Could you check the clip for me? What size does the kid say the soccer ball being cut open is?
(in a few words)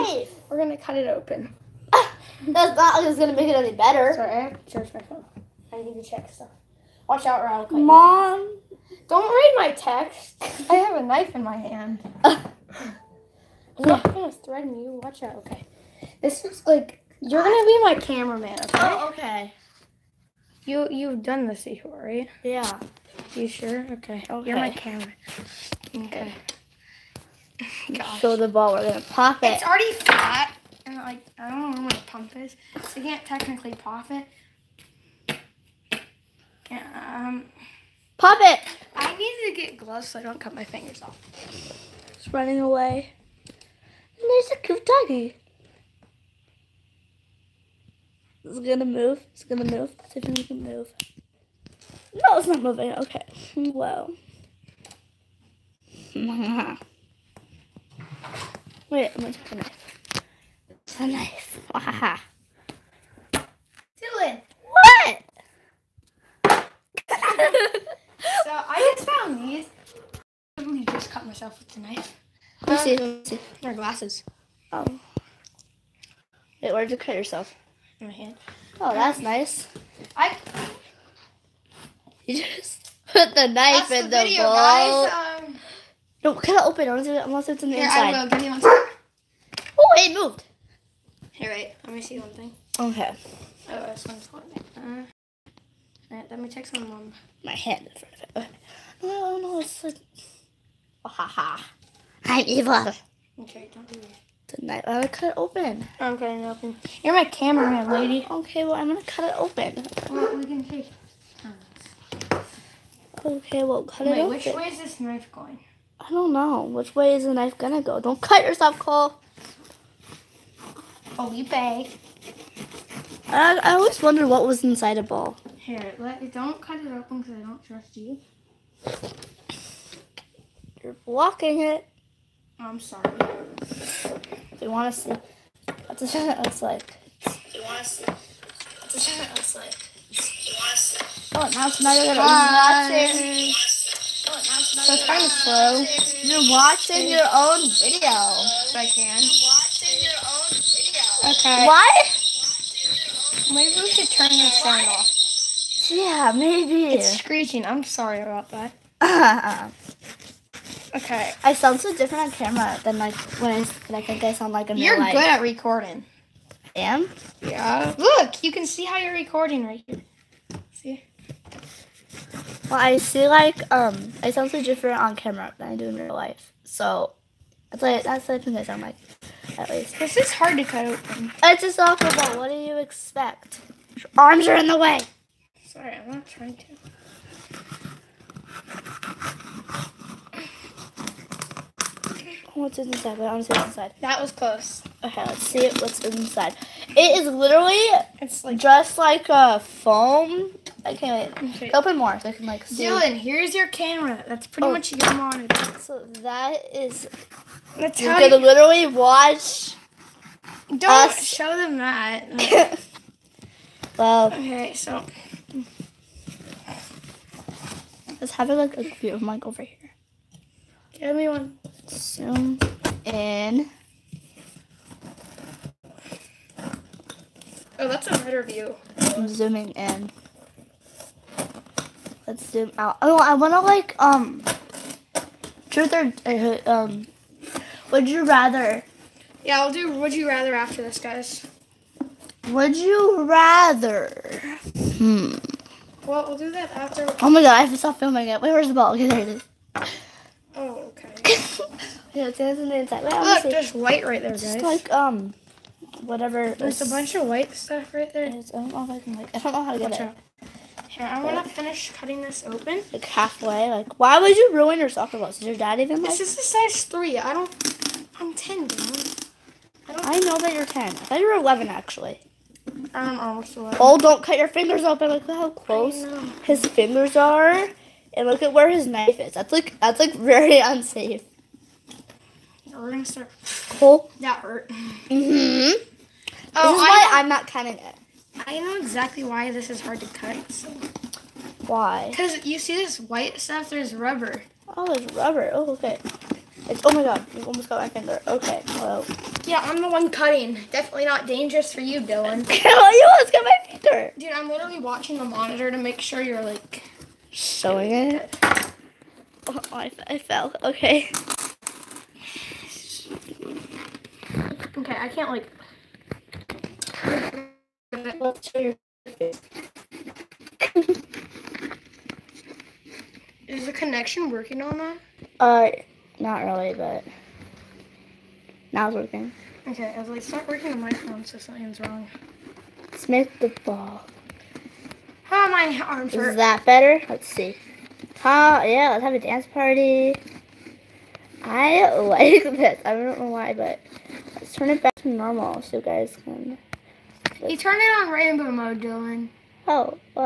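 3.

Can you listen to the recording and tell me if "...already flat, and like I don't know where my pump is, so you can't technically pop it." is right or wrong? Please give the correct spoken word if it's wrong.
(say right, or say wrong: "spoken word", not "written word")
right.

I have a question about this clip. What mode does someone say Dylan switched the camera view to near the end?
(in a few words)
Rainbow mode.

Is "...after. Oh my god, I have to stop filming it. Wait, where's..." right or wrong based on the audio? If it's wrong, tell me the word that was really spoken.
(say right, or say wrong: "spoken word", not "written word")
right.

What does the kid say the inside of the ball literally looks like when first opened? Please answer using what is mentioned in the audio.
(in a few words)
Foam.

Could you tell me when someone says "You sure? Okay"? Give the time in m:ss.
0:23.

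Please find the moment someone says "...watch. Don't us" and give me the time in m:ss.
3:28.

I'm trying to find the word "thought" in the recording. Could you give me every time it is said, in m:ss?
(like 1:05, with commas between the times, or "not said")
4:30.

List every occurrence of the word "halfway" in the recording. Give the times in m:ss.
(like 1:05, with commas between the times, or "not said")
4:23.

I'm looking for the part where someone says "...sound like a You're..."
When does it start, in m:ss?
2:44.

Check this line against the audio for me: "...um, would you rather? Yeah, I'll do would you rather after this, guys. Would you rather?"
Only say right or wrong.
right.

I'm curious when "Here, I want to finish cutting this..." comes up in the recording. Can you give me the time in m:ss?
4:20.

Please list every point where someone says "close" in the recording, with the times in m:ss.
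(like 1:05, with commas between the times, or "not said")
3:14, 4:35.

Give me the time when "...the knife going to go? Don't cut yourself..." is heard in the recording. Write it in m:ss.
1:57.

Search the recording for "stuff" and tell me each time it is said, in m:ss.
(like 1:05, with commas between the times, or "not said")
0:06, 4:17, 4:53.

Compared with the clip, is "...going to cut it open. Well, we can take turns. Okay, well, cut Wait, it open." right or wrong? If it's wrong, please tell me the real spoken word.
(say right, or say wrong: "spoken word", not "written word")
right.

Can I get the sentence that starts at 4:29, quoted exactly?
I, don't, I know that you're ten.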